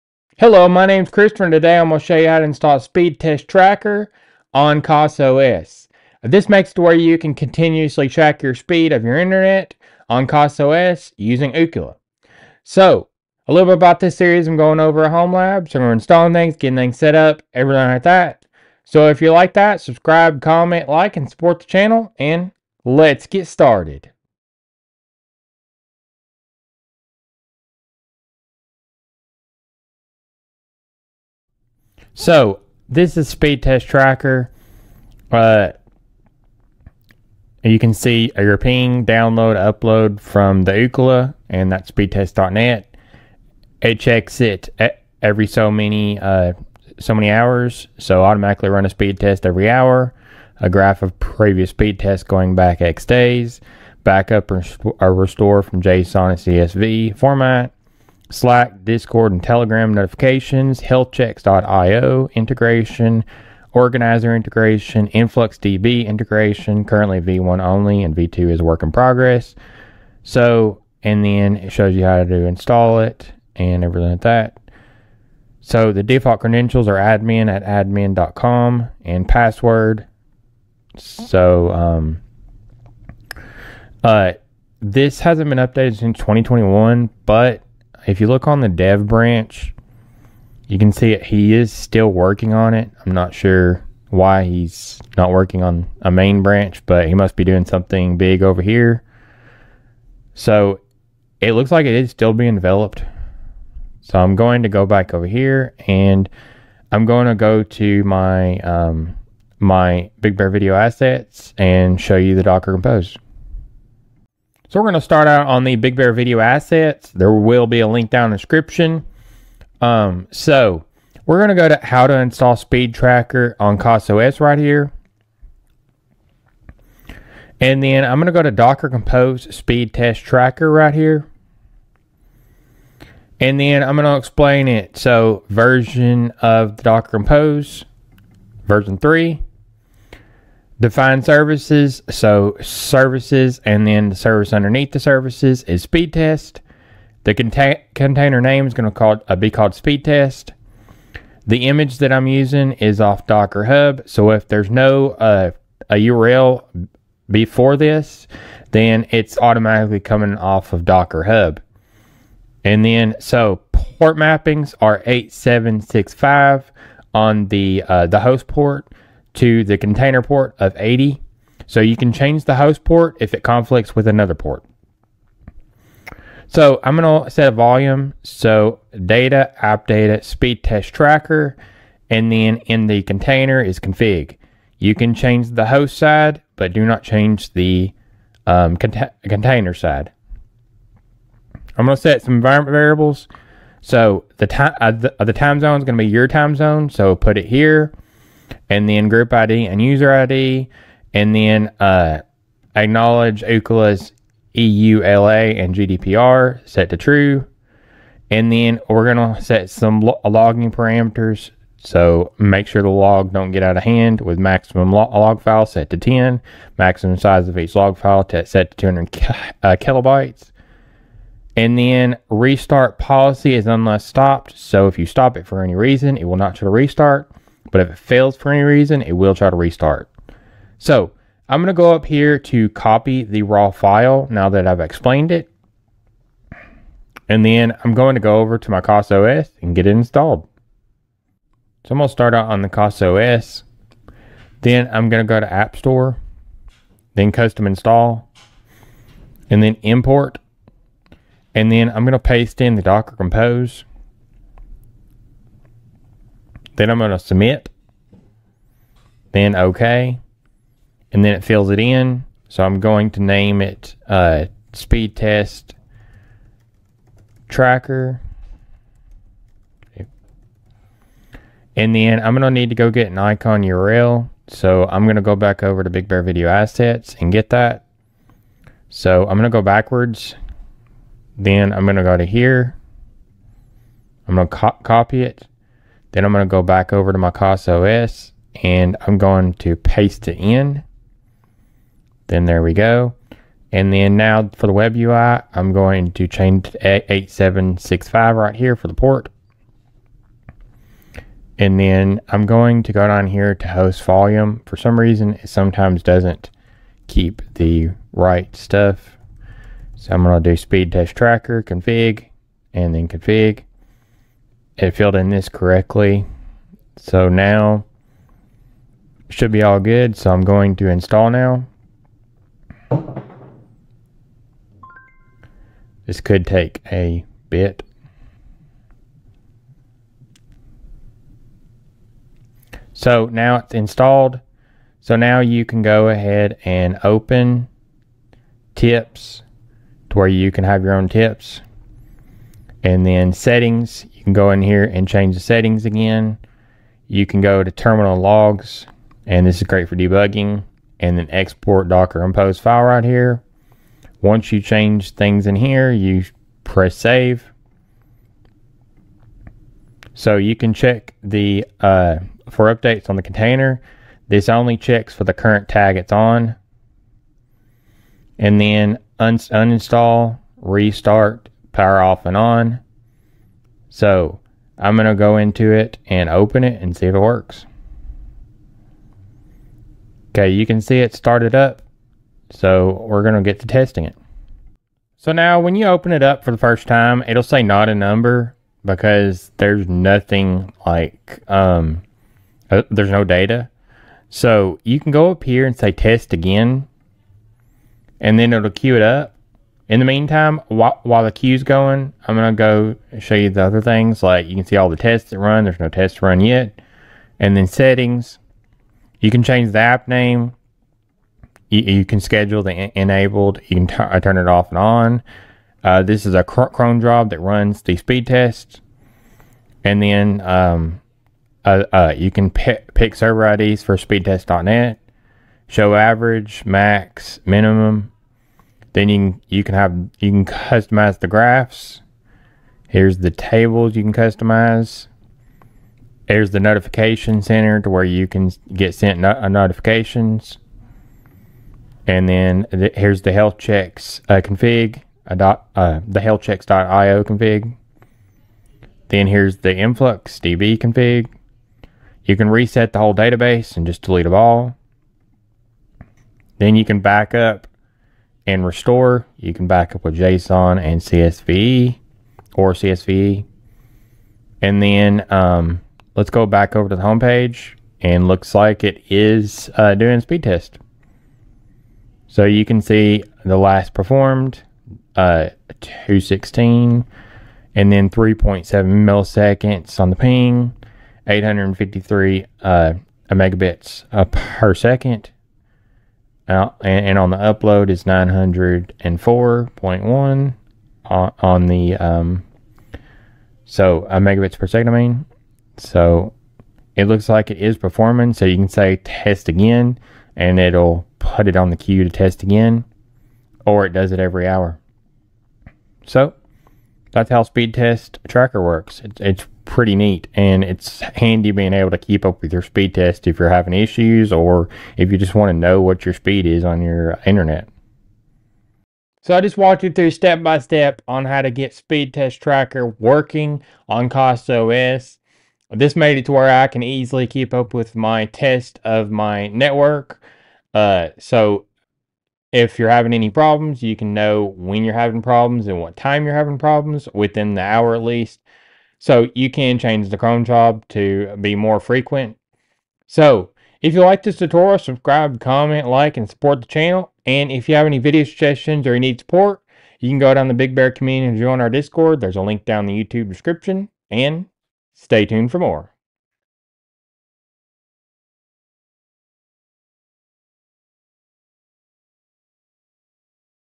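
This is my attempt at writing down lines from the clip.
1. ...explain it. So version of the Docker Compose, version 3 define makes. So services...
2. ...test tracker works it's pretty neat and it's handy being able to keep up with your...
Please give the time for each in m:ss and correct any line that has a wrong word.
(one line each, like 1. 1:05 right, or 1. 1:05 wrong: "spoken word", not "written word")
1. 2:14 wrong: "services", not "makes"
2. 8:27 right.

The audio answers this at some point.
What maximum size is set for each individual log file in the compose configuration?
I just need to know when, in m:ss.
3:38.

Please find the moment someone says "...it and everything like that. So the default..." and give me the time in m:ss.
1:12.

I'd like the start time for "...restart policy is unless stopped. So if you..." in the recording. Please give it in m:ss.
3:42.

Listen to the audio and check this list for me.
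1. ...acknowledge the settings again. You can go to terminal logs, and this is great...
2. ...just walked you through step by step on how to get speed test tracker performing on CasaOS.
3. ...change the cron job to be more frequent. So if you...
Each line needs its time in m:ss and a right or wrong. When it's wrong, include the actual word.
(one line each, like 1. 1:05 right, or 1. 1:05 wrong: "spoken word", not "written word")
1. 5:45 wrong: "change", not "acknowledge"
2. 8:39 wrong: "working", not "performing"
3. 8:59 right.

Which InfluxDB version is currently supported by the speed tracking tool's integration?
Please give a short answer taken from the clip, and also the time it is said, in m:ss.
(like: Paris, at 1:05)
V1, at 1:07.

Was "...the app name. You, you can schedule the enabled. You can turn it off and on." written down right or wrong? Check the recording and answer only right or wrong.
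right.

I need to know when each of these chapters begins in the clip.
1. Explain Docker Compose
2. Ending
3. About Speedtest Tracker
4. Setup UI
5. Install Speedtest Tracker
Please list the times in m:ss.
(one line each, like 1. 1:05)
1. 1:54
2. 8:38
3. 0:31
4. 6:24
5. 4:01.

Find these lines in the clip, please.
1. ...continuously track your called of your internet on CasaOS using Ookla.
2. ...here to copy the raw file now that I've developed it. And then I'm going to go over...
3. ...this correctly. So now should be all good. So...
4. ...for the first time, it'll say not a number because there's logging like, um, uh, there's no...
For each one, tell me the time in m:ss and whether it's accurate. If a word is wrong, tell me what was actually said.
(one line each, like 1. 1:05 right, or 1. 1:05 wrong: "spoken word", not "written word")
1. 0:07 wrong: "speed", not "called"
2. 3:52 wrong: "explained", not "developed"
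3. 5:15 right
4. 6:26 wrong: "nothing", not "logging".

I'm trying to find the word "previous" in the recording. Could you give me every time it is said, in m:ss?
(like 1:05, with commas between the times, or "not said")
0:51.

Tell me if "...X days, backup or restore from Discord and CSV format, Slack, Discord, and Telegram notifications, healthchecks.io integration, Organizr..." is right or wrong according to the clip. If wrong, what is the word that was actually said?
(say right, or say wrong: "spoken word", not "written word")
wrong: "JSON", not "Discord".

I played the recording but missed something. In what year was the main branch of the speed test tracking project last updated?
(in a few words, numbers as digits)
2021.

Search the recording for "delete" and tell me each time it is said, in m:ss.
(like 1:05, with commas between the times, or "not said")
7:34.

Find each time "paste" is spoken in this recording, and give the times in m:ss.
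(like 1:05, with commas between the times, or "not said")
4:12, 4:49.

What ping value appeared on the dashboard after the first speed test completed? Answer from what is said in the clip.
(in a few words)
3.7 milliseconds.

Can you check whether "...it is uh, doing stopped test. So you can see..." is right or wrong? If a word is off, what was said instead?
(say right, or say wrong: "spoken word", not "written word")
wrong: "speed", not "stopped".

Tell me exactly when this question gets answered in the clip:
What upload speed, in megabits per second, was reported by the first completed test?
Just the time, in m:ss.
8:08.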